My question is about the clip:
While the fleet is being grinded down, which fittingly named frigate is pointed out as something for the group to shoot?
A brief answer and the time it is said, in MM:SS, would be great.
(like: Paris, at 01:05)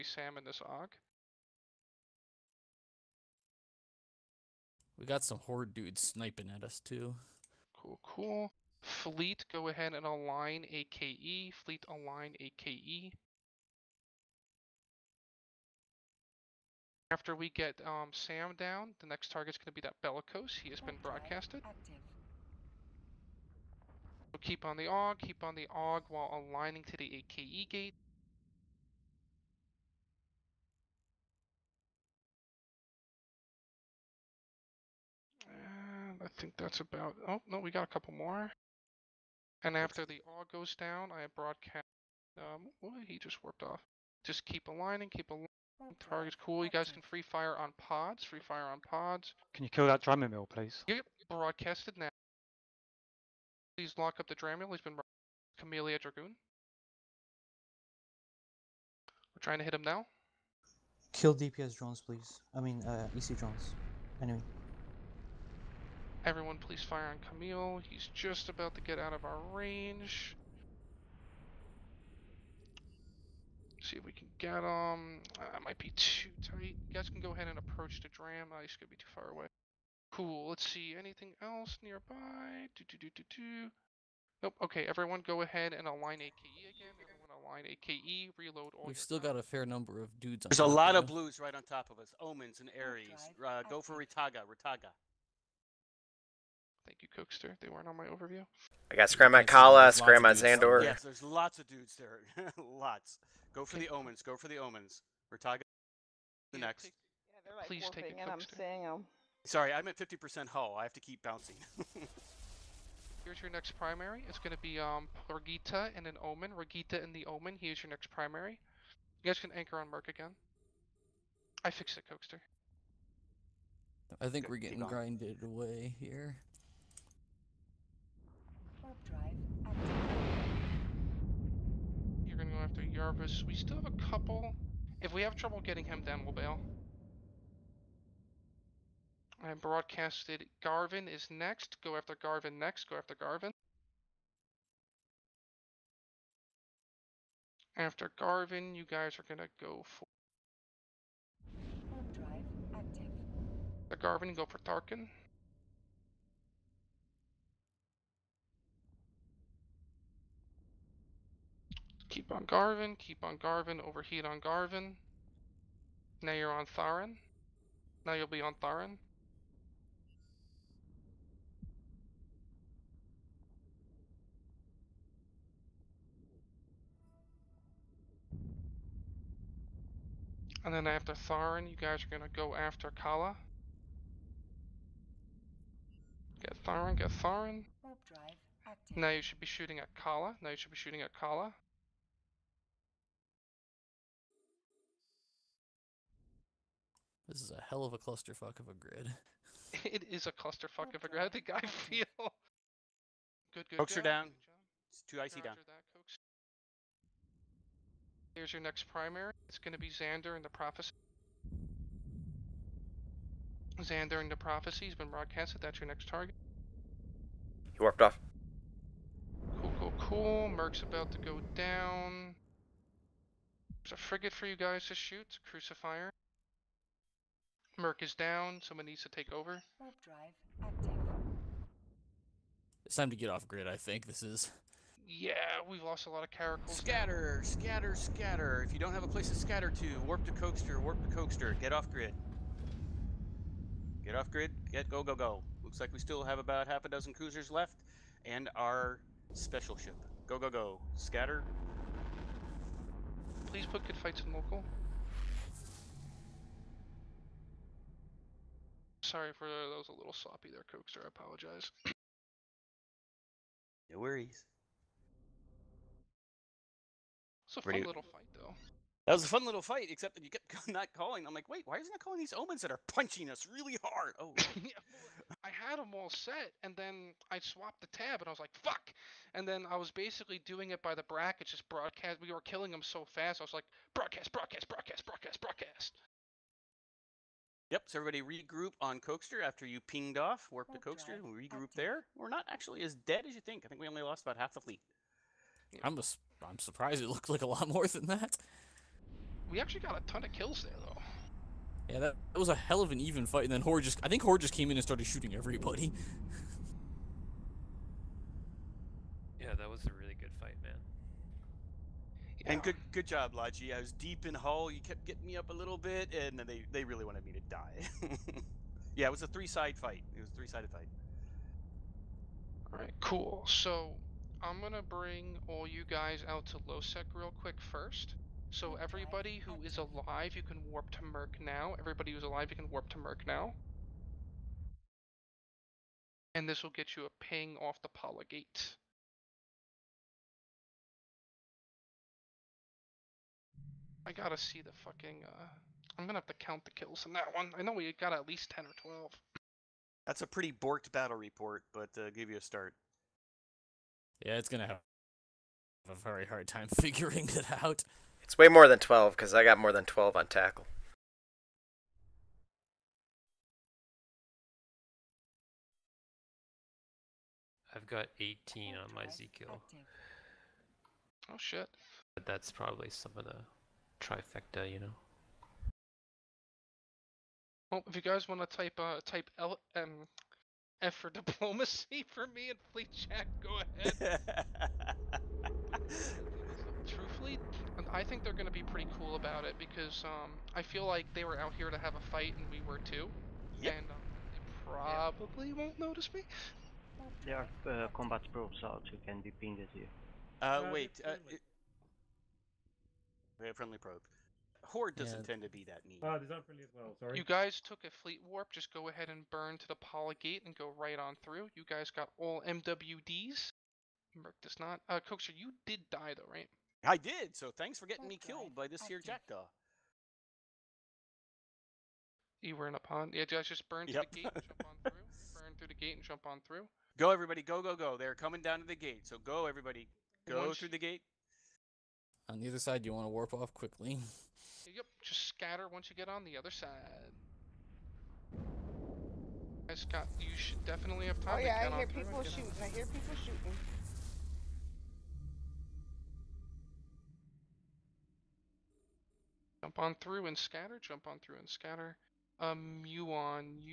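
Crucifier, at 03:45.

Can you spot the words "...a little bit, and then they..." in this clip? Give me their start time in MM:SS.
05:15.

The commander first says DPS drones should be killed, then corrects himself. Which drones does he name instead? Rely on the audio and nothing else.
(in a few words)
EC drones.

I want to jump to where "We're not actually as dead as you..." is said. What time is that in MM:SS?
04:52.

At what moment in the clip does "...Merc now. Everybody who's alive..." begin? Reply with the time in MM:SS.
05:31.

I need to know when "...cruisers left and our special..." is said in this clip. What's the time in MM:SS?
04:07.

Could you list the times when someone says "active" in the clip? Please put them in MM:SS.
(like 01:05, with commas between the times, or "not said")
02:09, 02:32, 03:50.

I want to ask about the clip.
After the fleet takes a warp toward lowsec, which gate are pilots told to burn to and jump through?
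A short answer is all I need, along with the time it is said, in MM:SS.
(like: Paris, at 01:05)
polygate, at 06:49.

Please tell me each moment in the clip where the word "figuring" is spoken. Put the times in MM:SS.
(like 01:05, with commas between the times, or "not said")
05:56.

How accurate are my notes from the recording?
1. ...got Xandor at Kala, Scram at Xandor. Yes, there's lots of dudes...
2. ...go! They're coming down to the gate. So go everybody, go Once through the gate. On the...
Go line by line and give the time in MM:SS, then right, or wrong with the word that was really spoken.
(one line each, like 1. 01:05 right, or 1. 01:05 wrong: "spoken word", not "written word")
1. 01:38 wrong: "Scram", not "Xandor"
2. 07:07 right.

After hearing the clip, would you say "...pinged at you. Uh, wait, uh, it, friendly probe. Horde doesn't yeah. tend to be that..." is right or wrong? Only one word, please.
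right.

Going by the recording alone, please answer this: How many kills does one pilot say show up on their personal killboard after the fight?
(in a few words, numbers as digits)
18.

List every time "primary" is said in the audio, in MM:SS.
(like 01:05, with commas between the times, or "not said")
01:53, 01:58, 03:28.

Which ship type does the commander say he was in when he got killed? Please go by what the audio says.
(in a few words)
jackdaw.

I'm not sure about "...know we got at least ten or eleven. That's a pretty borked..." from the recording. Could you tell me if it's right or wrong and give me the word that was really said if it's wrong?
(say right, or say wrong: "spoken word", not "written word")
wrong: "twelve", not "eleven".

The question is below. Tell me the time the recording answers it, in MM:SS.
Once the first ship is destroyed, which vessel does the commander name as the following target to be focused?
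00:20.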